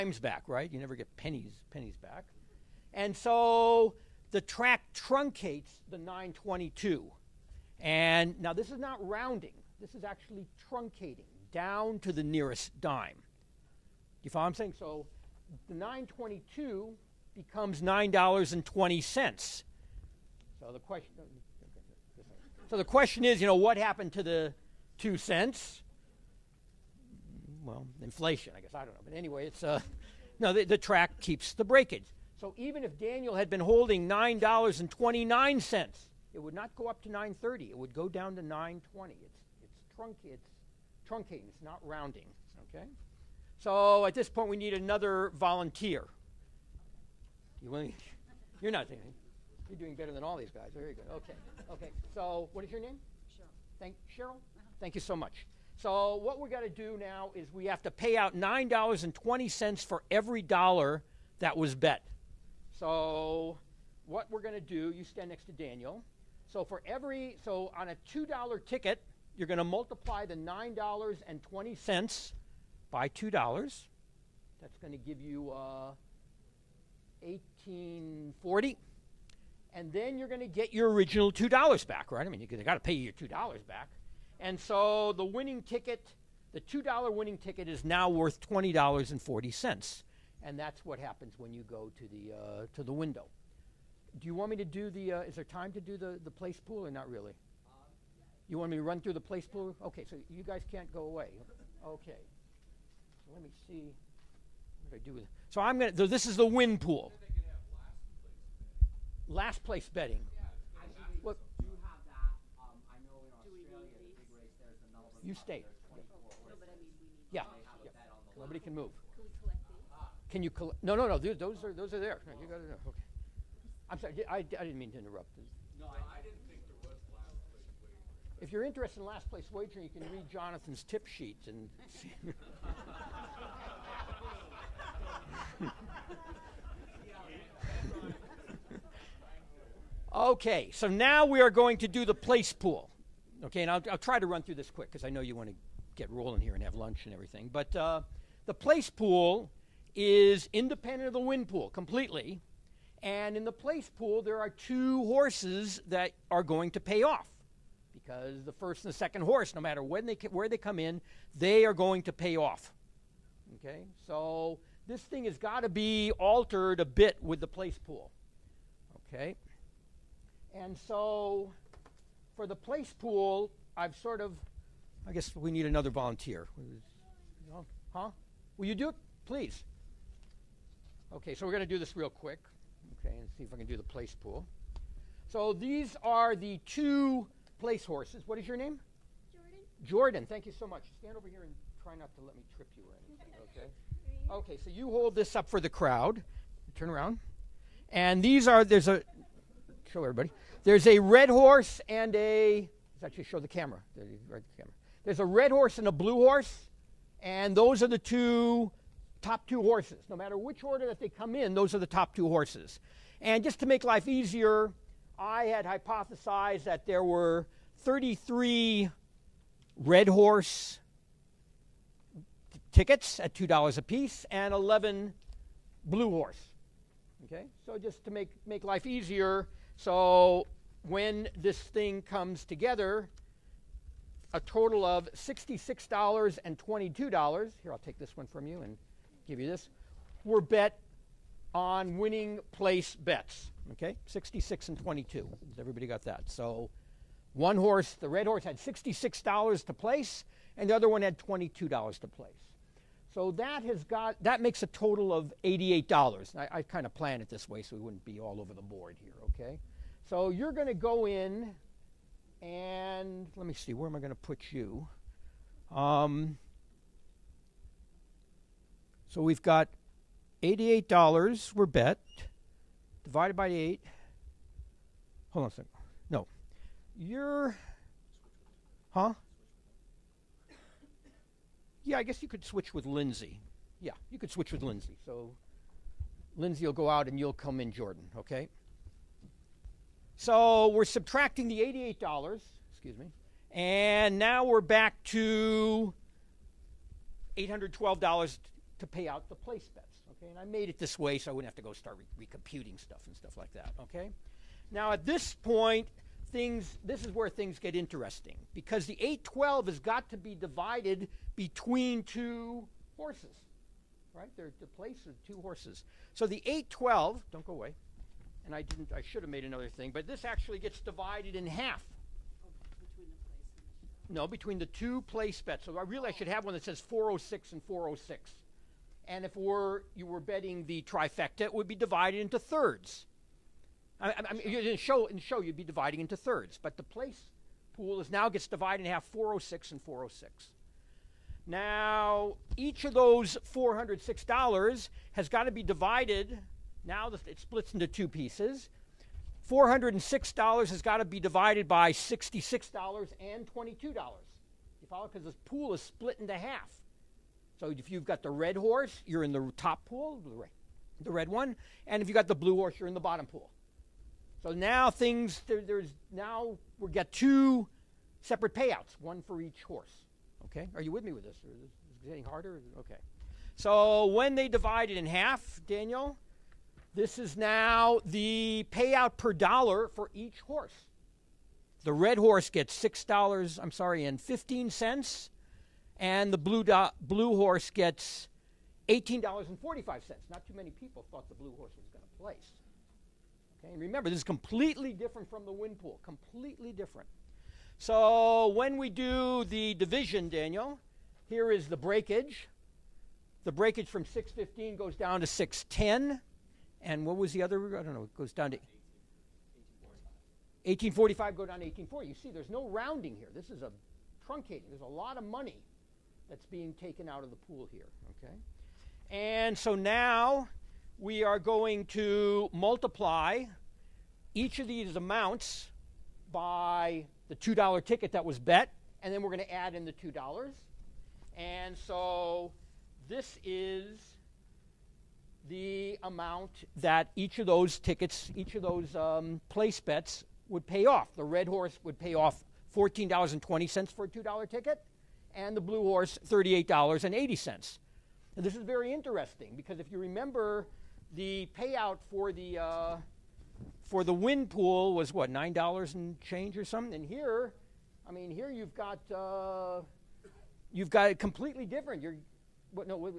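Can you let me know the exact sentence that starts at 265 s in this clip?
Um, so we've got $88 were bet divided by 8.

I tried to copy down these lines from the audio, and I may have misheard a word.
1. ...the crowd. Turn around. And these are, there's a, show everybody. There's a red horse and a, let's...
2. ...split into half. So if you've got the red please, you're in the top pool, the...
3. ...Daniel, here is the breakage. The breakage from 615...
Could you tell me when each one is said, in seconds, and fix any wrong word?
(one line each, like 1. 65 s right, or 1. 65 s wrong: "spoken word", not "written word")
1. 195 s right
2. 355 s wrong: "horse", not "please"
3. 400 s right.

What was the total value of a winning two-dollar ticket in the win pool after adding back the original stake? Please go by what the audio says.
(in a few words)
$20.40.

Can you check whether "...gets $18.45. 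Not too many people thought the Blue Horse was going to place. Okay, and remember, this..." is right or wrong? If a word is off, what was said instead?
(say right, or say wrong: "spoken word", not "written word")
right.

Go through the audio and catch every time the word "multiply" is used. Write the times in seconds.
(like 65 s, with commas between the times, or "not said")
69 s, 422 s.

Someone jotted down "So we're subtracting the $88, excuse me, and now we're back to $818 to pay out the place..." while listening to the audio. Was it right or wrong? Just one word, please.
wrong.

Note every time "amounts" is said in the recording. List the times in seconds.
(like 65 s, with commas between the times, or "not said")
424 s, 436 s.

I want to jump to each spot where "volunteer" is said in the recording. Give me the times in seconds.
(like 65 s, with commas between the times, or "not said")
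45 s, 175 s.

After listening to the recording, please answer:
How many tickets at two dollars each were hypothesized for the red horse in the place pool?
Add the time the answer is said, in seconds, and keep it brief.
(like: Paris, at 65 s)
33, at 217 s.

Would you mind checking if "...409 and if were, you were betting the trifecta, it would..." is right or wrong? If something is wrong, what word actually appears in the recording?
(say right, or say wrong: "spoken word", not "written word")
wrong: "406", not "409".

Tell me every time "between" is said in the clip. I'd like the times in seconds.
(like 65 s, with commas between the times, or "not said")
311 s, 324 s.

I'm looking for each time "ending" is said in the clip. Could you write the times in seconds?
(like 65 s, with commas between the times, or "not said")
not said.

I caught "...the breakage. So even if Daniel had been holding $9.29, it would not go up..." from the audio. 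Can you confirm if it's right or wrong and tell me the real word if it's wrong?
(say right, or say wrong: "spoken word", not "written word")
right.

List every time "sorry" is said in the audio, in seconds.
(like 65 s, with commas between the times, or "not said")
123 s, 383 s.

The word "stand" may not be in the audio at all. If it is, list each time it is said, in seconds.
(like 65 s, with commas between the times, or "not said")
65 s, 190 s.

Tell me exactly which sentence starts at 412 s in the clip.
You see, there's no rounding here.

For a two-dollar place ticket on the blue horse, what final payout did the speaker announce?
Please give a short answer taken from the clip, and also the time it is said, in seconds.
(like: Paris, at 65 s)
$38.80, at 446 s.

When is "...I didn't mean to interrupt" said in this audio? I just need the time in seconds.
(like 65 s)
124 s.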